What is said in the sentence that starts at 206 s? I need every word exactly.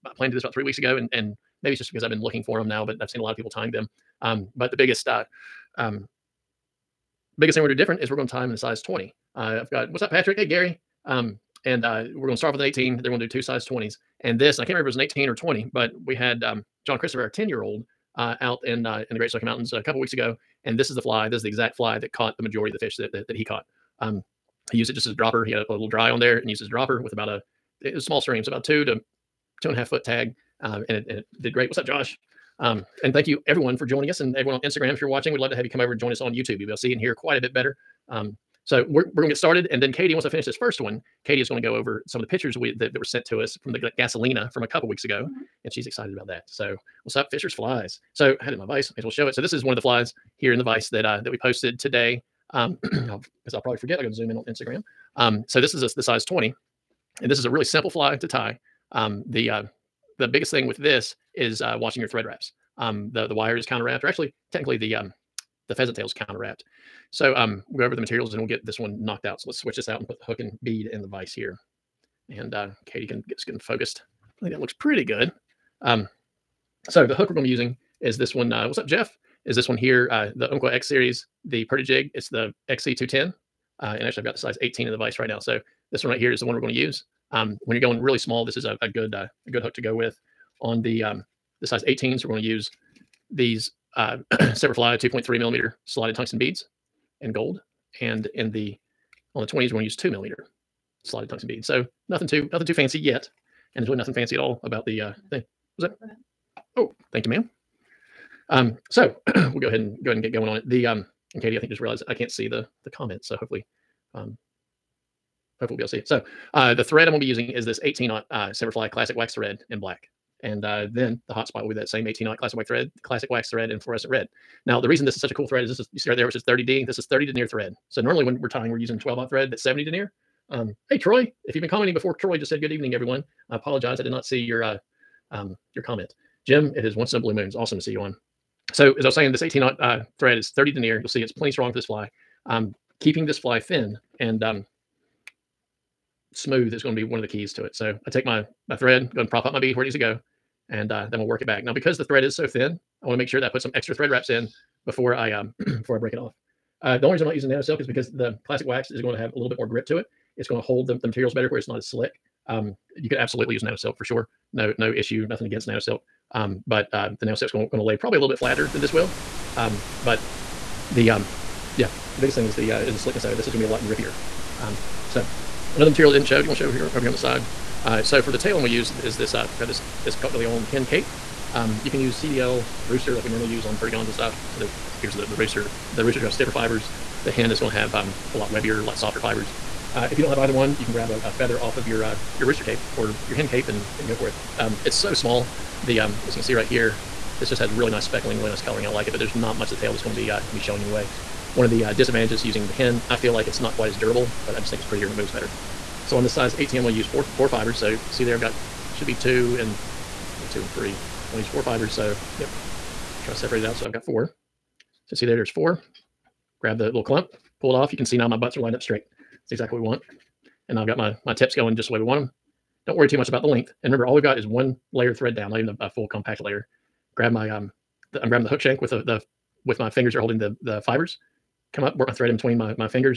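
So on this size 18, I'm going to use four, four fibers.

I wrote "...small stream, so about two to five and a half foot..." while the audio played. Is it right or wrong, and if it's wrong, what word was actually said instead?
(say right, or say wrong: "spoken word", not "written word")
wrong: "two", not "five".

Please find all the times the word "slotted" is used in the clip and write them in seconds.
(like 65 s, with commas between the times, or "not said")
95 s, 101 s.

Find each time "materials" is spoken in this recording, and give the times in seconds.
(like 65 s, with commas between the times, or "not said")
68 s, 161 s, 175 s.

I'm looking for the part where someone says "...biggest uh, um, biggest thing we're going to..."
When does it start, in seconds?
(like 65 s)
4 s.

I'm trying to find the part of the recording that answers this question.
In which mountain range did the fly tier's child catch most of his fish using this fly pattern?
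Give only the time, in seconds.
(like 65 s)
19 s.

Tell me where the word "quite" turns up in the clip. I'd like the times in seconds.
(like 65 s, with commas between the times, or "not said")
37 s, 203 s.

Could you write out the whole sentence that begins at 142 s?
I'm keeping this fly thin and um, smooth is going to be one of the keys to it.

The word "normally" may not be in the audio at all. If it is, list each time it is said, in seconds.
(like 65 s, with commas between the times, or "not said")
127 s, 183 s.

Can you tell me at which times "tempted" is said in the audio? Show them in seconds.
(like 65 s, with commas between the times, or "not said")
not said.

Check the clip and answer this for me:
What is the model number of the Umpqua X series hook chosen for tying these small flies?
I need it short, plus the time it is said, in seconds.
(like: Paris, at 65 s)
XC210, at 82 s.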